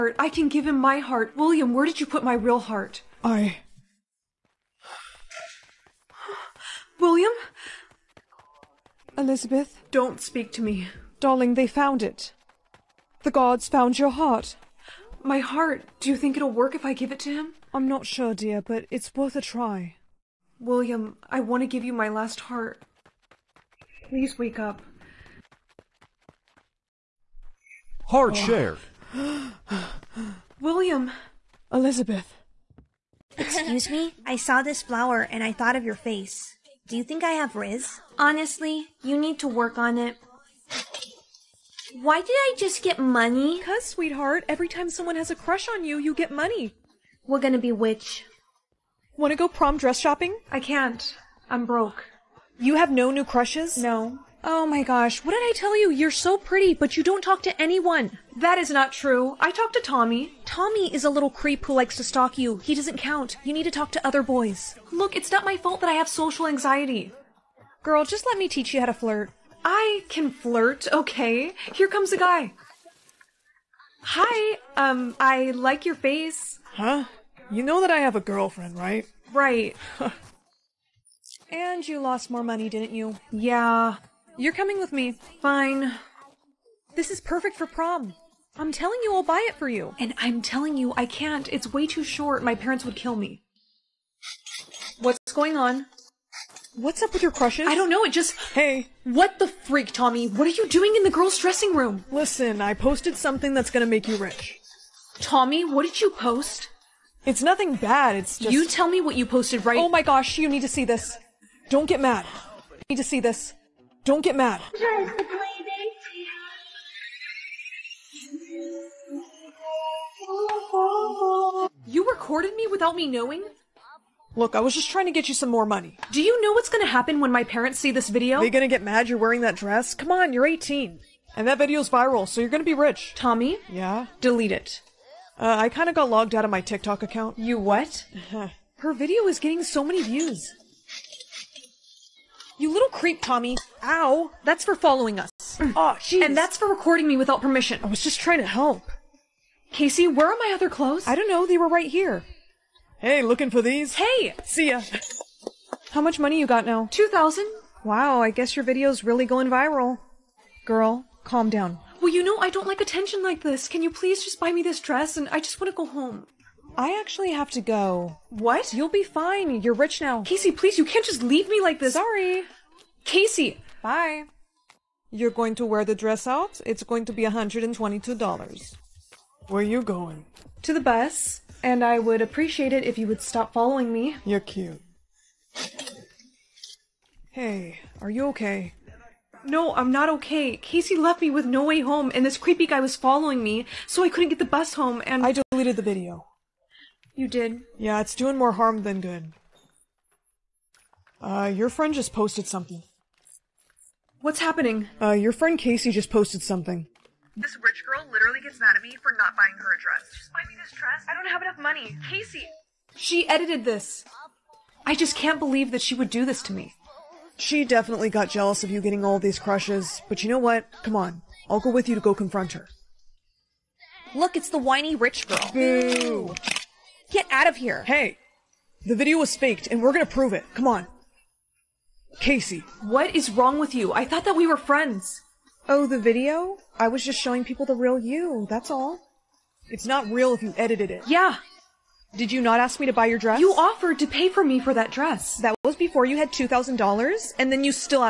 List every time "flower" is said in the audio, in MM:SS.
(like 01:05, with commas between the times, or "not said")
00:34.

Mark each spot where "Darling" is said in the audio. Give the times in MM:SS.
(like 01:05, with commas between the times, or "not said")
00:11.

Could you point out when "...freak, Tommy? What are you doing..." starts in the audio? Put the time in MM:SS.
01:39.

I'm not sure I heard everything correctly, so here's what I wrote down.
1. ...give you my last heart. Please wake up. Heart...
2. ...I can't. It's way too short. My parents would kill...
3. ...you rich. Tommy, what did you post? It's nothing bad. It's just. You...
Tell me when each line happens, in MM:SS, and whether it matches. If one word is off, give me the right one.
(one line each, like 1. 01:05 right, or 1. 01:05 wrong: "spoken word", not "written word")
1. 00:21 right
2. 01:30 right
3. 01:44 right.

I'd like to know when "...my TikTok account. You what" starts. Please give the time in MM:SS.
02:16.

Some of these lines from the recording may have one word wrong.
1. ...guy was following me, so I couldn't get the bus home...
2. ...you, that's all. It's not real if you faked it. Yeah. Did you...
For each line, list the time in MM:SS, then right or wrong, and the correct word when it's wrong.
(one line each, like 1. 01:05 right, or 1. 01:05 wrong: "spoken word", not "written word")
1. 03:12 right
2. 03:57 wrong: "edited", not "faked".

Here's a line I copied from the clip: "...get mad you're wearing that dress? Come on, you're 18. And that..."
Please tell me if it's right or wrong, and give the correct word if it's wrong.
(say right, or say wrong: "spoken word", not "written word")
right.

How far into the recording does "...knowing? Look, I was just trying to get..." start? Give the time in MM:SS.
02:03.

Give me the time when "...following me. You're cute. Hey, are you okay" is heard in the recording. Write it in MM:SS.
03:03.